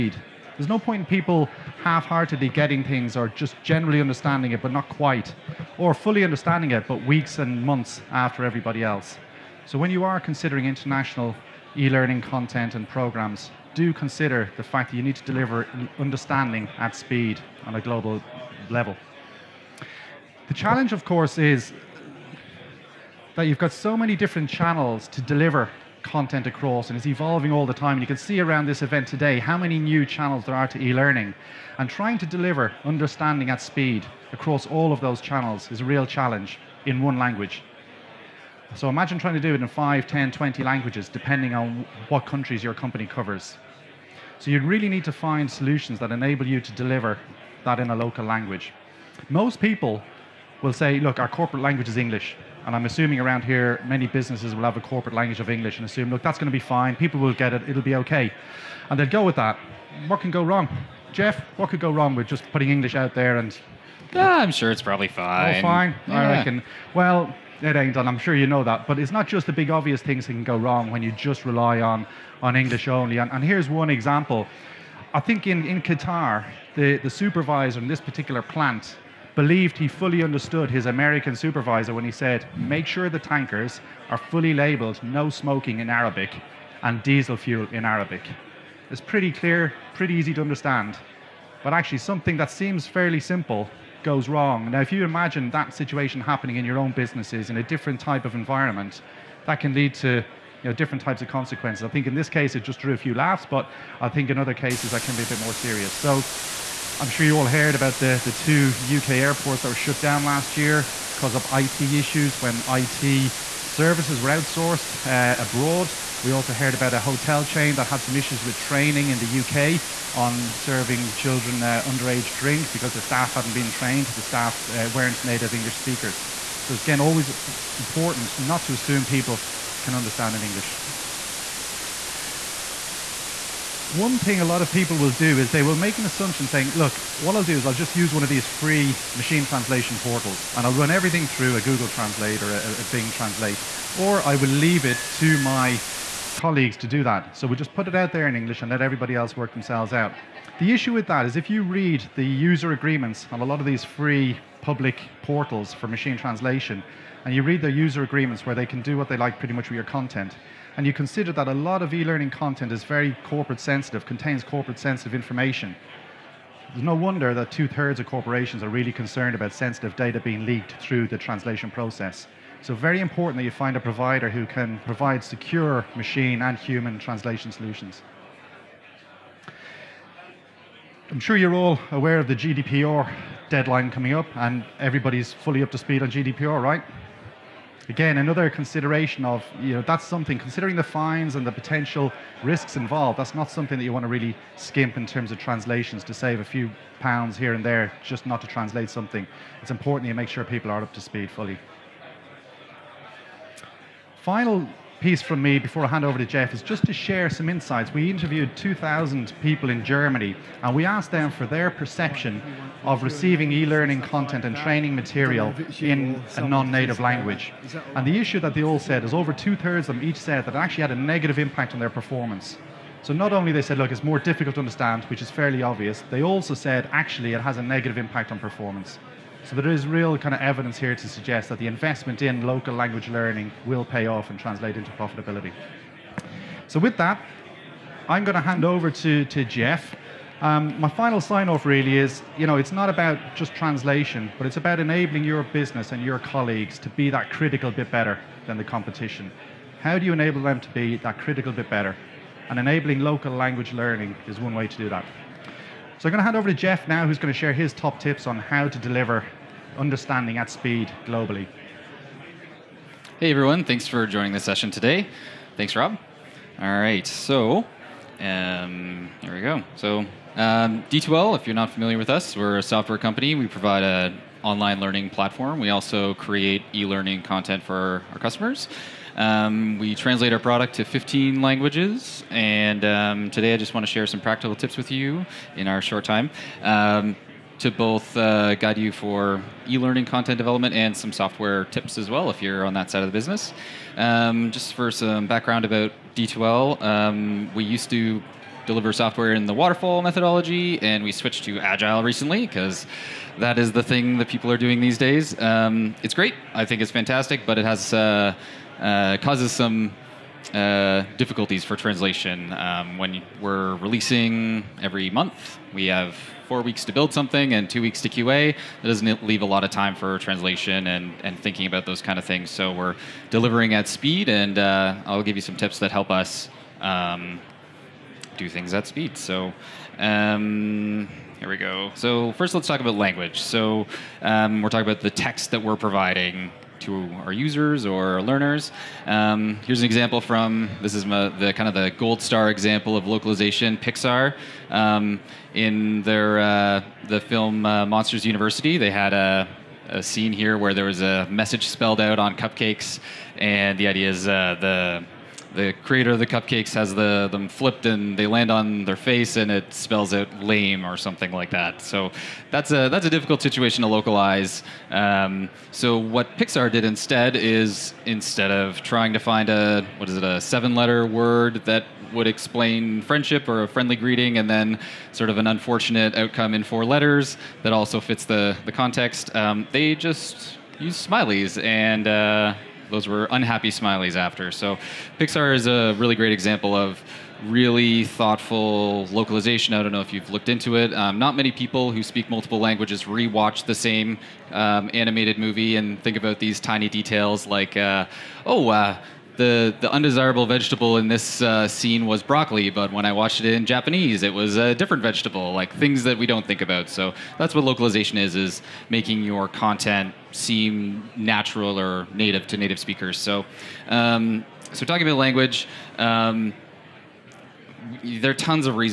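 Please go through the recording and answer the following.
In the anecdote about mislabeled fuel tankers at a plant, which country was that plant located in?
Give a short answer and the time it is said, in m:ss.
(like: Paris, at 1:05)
Qatar, at 1:15.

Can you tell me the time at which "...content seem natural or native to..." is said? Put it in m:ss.
6:49.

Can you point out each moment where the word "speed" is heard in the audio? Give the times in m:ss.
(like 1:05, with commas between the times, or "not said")
0:16, 0:33, 3:05, 3:20, 4:20, 5:23, 5:28.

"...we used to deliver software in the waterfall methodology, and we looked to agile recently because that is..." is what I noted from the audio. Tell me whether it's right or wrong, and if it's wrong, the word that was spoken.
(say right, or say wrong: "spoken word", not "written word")
wrong: "switched", not "looked".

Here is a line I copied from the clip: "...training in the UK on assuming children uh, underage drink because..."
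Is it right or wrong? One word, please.
wrong.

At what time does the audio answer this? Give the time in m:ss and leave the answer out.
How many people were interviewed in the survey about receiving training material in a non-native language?
3:28.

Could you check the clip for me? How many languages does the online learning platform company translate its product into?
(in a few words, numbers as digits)
15.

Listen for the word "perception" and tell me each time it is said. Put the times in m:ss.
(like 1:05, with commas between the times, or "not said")
3:31.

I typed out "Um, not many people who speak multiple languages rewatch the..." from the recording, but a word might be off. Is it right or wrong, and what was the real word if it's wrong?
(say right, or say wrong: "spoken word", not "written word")
right.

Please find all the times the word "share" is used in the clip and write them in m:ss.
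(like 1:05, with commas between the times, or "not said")
3:26, 4:17, 4:43.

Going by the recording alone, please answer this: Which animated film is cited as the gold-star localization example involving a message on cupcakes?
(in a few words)
Monsters University.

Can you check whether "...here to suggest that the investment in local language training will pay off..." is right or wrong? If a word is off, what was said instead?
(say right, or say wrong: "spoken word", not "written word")
wrong: "learning", not "training".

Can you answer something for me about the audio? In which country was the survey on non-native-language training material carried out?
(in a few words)
Germany.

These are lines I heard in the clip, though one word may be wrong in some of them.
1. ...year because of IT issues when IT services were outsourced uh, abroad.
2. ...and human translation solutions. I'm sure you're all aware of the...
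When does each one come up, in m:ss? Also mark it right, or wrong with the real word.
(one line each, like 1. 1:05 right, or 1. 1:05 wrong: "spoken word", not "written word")
1. 1:50 right
2. 2:56 right.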